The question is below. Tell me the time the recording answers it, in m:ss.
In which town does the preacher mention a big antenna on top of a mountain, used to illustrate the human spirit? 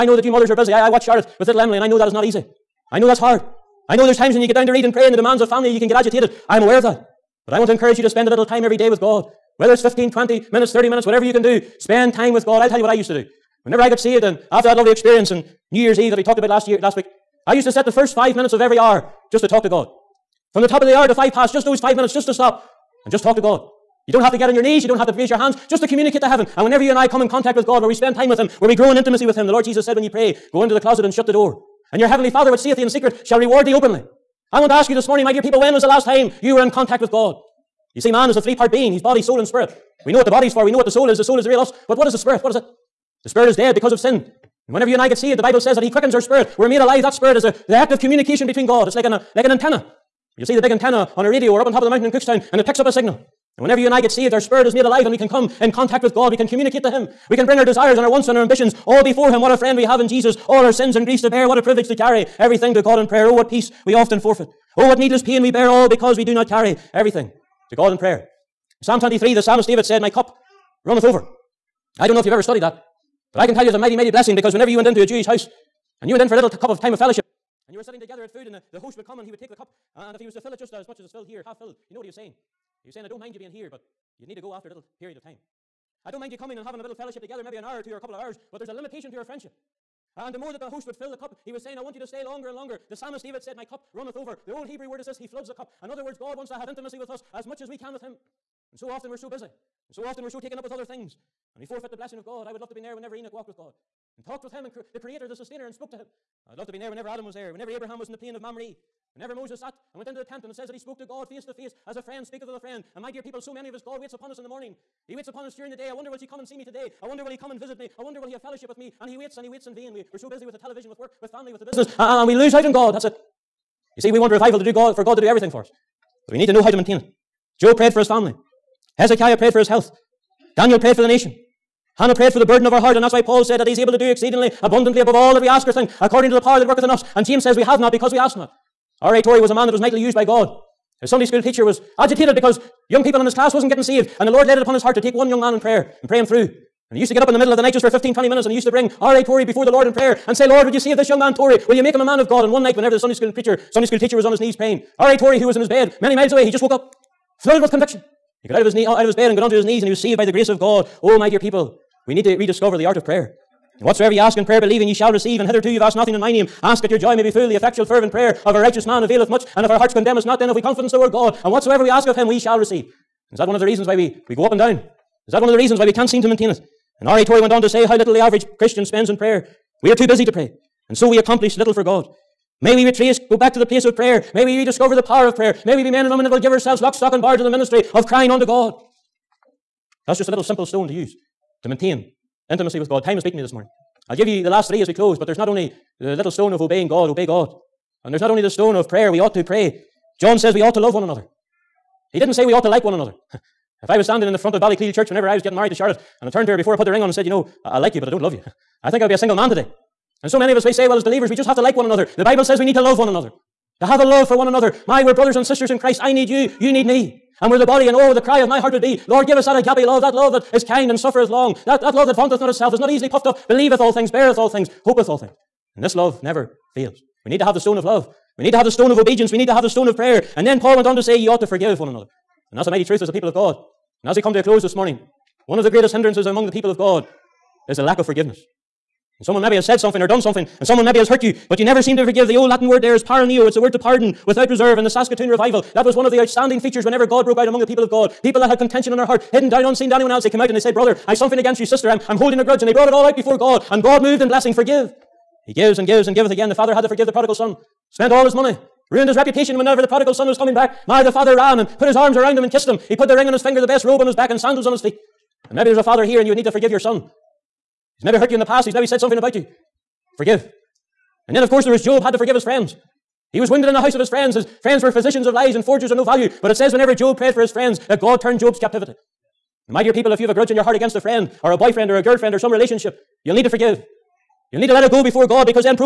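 0:52.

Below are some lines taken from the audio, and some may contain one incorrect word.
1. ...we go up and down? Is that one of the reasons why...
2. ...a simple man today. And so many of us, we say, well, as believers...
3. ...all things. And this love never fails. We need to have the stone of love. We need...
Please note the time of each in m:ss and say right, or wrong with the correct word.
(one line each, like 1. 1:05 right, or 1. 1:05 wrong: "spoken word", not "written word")
1. 2:54 right
2. 3:29 wrong: "single", not "simple"
3. 3:45 right.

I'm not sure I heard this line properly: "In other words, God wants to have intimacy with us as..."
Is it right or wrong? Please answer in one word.
right.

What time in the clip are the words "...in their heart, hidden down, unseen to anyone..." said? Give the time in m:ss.
4:08.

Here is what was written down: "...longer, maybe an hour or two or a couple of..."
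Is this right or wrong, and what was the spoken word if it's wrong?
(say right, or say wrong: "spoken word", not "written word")
wrong: "together", not "longer".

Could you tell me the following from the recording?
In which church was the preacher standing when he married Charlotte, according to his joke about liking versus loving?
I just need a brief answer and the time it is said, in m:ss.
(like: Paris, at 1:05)
Ballycleal Church, at 3:24.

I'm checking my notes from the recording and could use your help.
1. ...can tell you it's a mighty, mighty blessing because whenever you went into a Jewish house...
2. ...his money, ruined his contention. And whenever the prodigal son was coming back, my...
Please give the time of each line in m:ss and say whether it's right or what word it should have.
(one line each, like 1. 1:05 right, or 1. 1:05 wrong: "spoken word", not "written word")
1. 1:13 right
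2. 4:18 wrong: "reputation", not "contention".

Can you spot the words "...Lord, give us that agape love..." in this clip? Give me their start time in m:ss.
3:39.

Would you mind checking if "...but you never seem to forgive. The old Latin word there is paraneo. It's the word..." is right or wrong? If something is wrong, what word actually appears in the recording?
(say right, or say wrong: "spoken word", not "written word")
right.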